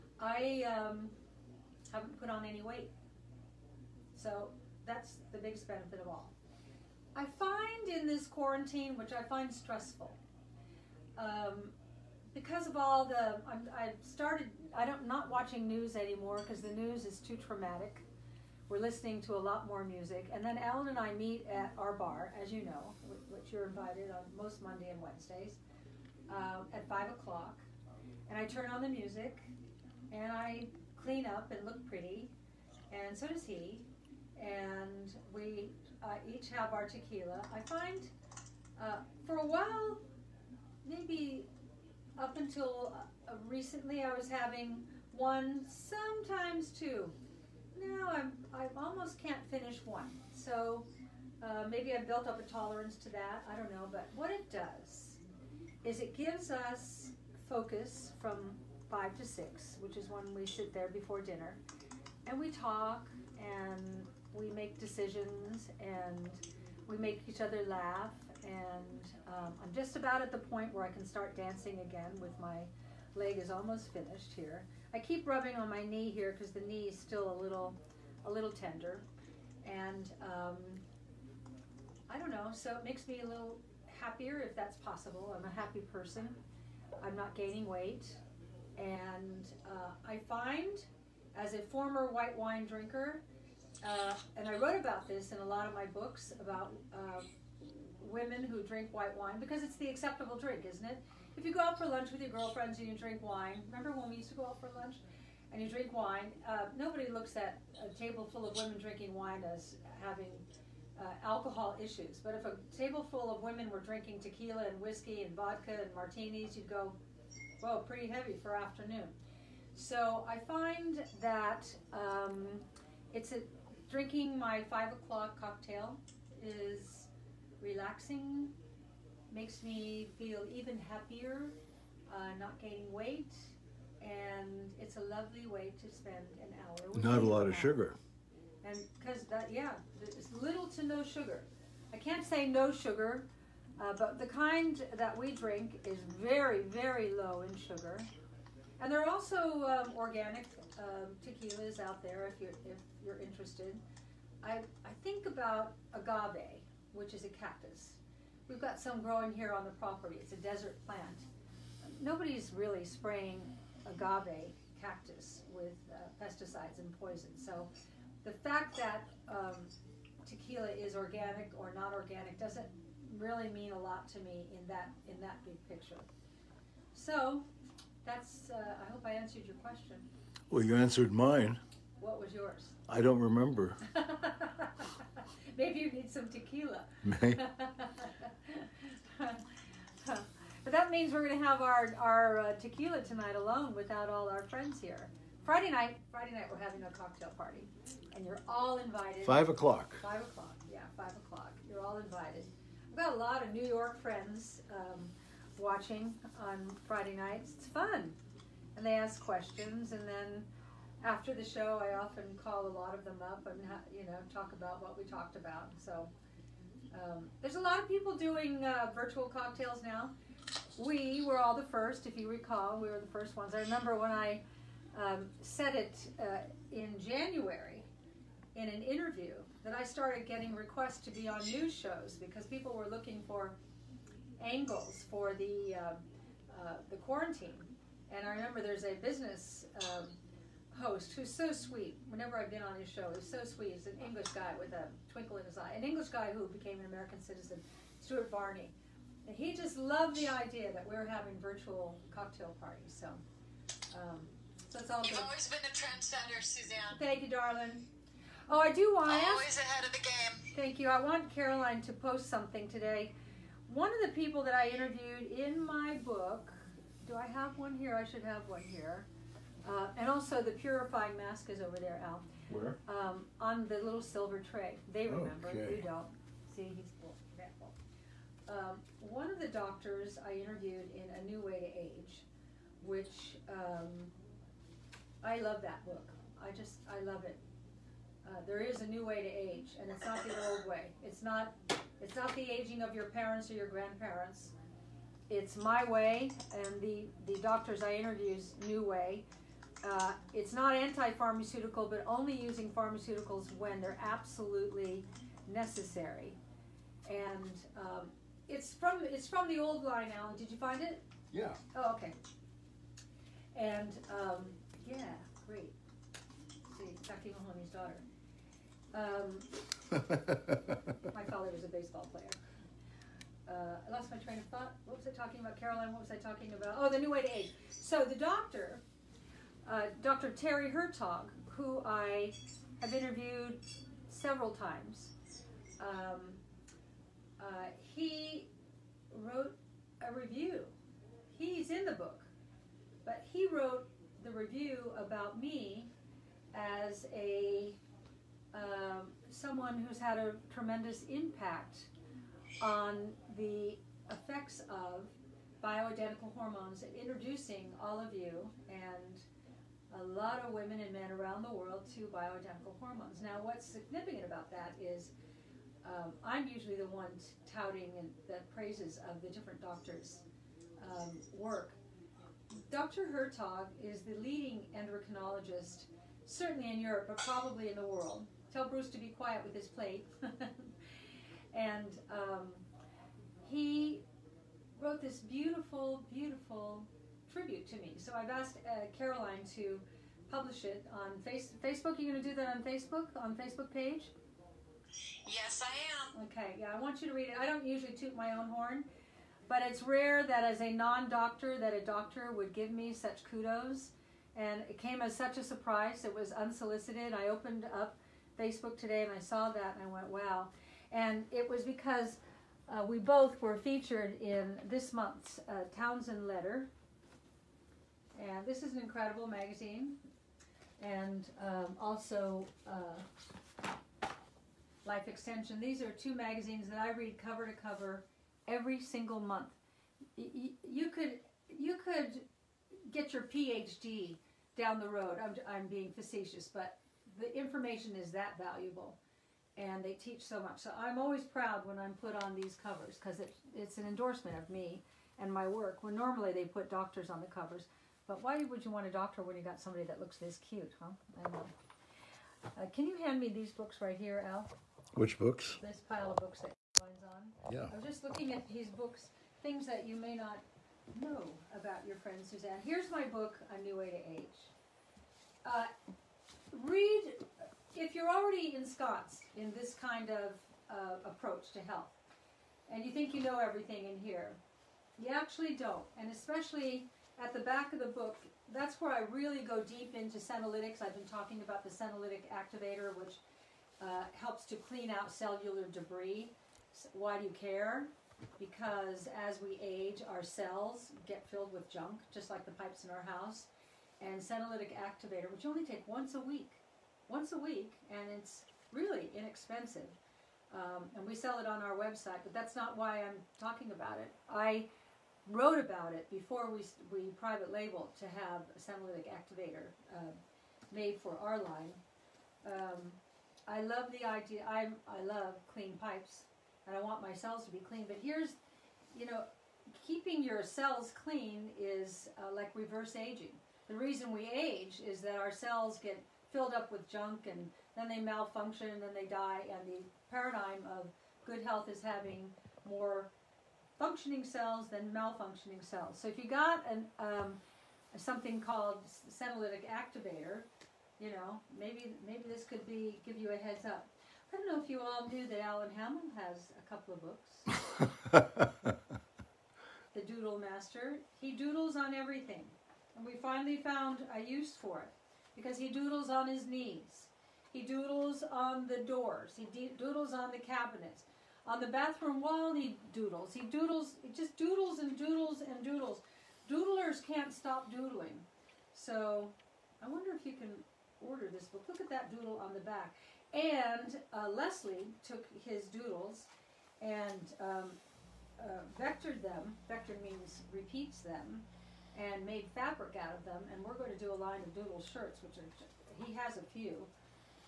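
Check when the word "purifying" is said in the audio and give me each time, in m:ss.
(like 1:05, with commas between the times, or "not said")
4:30.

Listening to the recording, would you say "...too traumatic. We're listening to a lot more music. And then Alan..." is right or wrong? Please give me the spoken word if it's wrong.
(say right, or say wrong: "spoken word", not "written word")
right.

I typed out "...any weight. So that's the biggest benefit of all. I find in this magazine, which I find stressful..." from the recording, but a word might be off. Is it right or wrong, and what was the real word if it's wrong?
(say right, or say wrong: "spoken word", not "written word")
wrong: "quarantine", not "magazine".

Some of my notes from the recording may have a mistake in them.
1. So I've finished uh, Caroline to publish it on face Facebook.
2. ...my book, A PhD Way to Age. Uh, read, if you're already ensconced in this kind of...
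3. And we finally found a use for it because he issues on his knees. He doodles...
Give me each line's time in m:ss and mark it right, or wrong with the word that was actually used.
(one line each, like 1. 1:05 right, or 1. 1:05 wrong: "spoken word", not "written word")
1. 6:27 wrong: "asked", not "finished"
2. 7:42 wrong: "New", not "PhD"
3. 9:12 wrong: "doodles", not "issues".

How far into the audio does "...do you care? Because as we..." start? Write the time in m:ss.
8:07.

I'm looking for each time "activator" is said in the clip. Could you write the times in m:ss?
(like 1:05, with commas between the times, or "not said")
8:02, 8:14, 8:29, 8:59.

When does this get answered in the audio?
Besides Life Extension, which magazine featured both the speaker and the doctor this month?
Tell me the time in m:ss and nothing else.
6:55.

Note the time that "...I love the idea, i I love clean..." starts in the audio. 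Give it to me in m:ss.
8:33.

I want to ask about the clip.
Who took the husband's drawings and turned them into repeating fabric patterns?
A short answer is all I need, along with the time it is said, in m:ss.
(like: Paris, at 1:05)
Leslie, at 9:34.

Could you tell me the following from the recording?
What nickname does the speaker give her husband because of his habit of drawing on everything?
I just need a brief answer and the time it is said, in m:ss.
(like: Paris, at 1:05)
The Doodle Master, at 9:09.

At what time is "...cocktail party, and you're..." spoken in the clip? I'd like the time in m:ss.
3:16.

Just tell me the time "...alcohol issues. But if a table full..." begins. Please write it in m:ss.
1:51.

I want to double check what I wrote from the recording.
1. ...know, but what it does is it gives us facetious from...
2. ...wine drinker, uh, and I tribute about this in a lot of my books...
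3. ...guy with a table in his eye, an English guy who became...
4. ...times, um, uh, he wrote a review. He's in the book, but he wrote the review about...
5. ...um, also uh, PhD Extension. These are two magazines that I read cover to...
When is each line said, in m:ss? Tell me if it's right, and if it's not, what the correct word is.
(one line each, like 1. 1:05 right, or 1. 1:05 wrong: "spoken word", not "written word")
1. 0:53 wrong: "focus", not "facetious"
2. 1:32 wrong: "wrote", not "tribute"
3. 4:04 wrong: "twinkle", not "table"
4. 5:34 right
5. 7:01 wrong: "Life", not "PhD".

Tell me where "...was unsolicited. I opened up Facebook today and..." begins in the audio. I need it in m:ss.
6:46.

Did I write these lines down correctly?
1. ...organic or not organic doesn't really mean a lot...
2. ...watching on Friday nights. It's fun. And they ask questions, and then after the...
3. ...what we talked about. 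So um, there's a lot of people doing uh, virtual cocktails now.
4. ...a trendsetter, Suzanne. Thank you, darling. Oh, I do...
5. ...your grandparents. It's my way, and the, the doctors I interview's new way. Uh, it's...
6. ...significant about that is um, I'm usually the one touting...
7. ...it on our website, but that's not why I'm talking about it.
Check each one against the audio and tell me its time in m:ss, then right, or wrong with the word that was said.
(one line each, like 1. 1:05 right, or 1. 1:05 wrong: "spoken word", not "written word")
1. 2:50 right
2. 3:25 right
3. 3:34 right
4. 4:15 right
5. 4:53 right
6. 6:03 right
7. 8:21 right.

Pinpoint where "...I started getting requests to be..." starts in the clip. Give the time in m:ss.
3:49.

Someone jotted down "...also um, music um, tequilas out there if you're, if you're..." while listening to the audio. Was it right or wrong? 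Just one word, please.
wrong.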